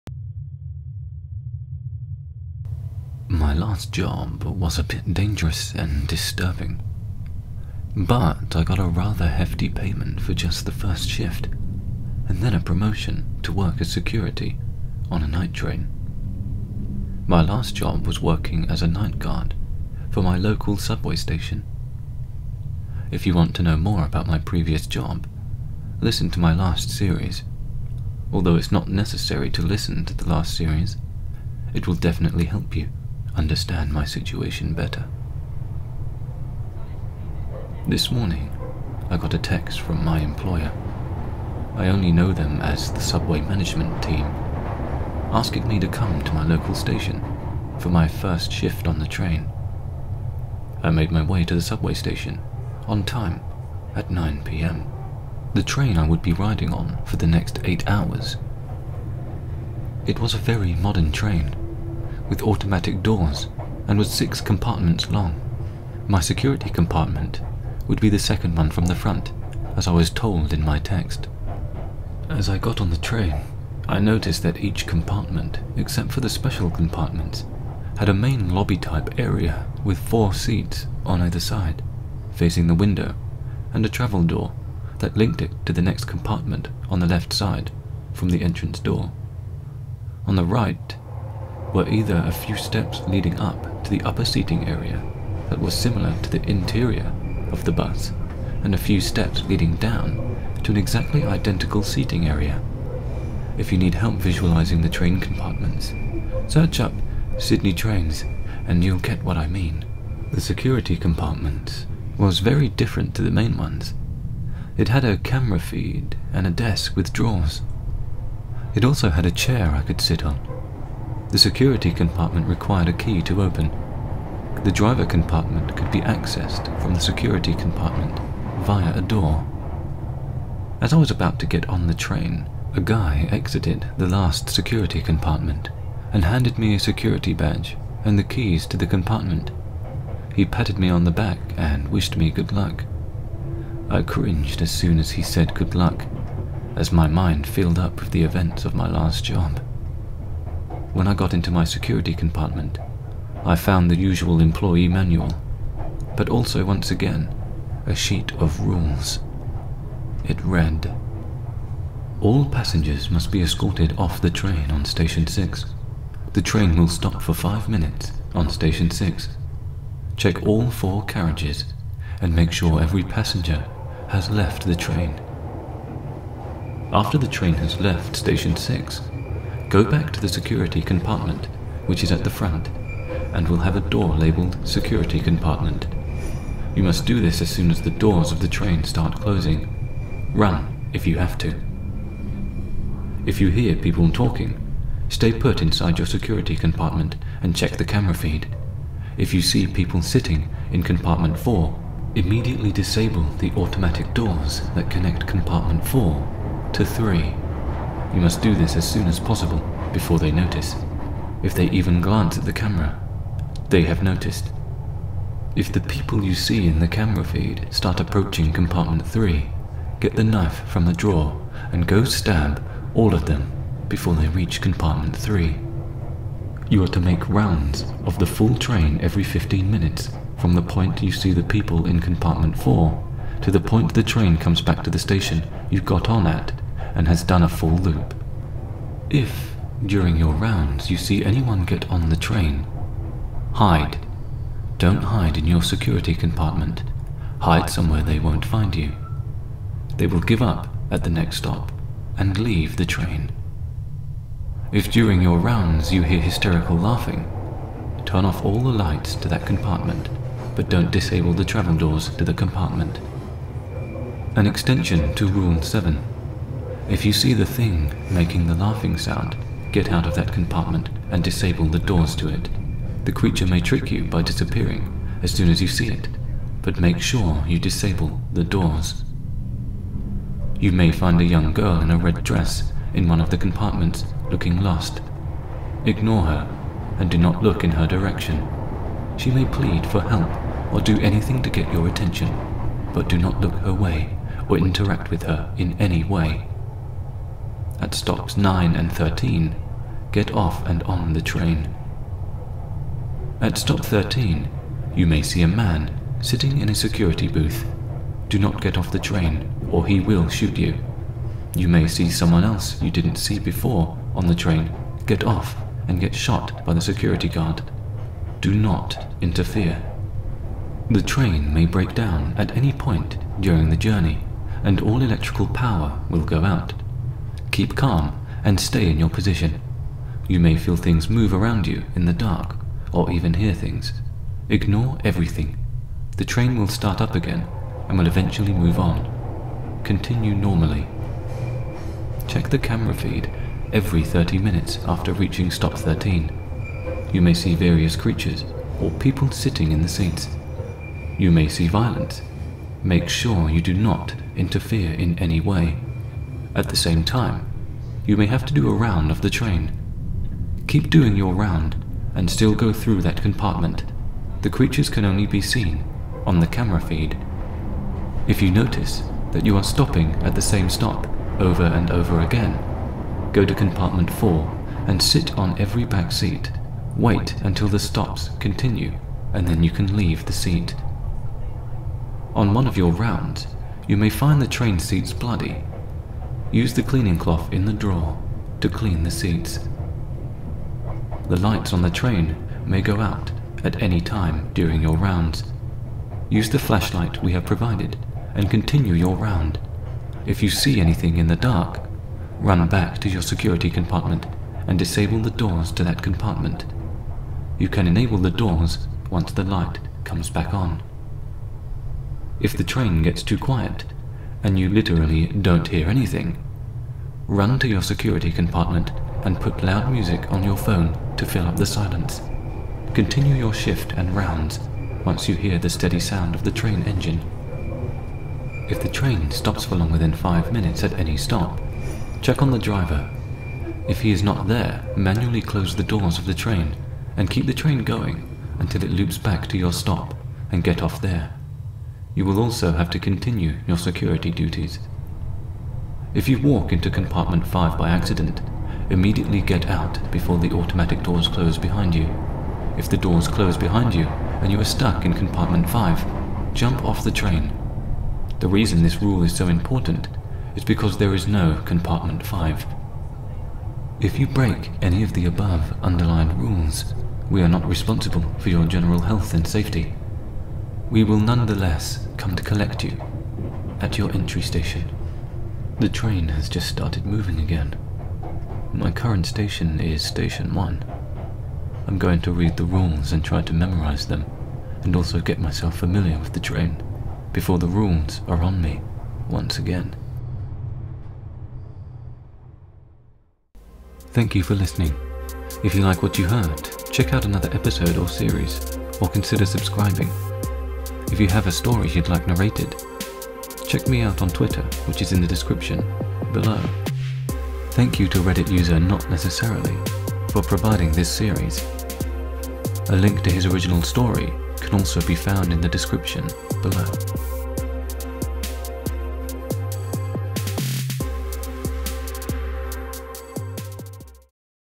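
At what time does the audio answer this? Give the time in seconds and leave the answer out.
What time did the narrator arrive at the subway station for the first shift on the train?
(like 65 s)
54 s.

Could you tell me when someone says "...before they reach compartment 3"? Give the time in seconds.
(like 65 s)
223 s.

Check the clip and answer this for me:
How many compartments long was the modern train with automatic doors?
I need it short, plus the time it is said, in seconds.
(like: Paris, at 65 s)
6, at 64 s.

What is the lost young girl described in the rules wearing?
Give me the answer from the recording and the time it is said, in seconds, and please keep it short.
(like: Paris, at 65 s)
a red dress, at 281 s.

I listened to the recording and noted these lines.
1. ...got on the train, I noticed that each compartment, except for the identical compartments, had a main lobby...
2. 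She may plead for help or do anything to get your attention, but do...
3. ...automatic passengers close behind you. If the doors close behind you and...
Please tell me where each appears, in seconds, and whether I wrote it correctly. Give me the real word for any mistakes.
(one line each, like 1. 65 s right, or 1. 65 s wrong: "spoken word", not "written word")
1. 72 s wrong: "special", not "identical"
2. 289 s right
3. 450 s wrong: "doors", not "passengers".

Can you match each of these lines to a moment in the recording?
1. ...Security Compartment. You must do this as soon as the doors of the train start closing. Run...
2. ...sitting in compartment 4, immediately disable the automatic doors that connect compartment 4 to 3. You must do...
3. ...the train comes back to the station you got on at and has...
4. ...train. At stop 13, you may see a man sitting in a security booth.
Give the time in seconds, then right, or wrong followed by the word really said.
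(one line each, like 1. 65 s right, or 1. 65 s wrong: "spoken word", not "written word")
1. 184 s right
2. 200 s right
3. 233 s right
4. 301 s right.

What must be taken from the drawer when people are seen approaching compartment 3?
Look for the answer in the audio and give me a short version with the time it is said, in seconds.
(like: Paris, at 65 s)
knife, at 220 s.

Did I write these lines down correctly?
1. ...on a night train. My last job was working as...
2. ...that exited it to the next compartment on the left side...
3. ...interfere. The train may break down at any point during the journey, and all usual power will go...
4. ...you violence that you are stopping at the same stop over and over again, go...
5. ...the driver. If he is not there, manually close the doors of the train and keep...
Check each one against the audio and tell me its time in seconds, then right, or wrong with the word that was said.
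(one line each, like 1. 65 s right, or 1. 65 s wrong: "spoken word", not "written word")
1. 15 s right
2. 84 s wrong: "linked", not "exited"
3. 319 s wrong: "electrical", not "usual"
4. 368 s wrong: "notice", not "violence"
5. 432 s right.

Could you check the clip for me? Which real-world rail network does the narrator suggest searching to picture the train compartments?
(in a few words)
Sydney trains.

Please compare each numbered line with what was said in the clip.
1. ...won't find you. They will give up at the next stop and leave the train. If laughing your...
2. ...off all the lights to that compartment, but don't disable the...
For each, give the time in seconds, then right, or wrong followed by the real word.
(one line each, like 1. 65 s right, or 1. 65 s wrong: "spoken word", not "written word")
1. 248 s wrong: "during", not "laughing"
2. 258 s right.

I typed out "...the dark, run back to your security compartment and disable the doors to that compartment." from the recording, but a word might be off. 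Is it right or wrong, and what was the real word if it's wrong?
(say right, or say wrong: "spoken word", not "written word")
right.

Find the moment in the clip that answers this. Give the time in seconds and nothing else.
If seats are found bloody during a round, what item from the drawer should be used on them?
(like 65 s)
386 s.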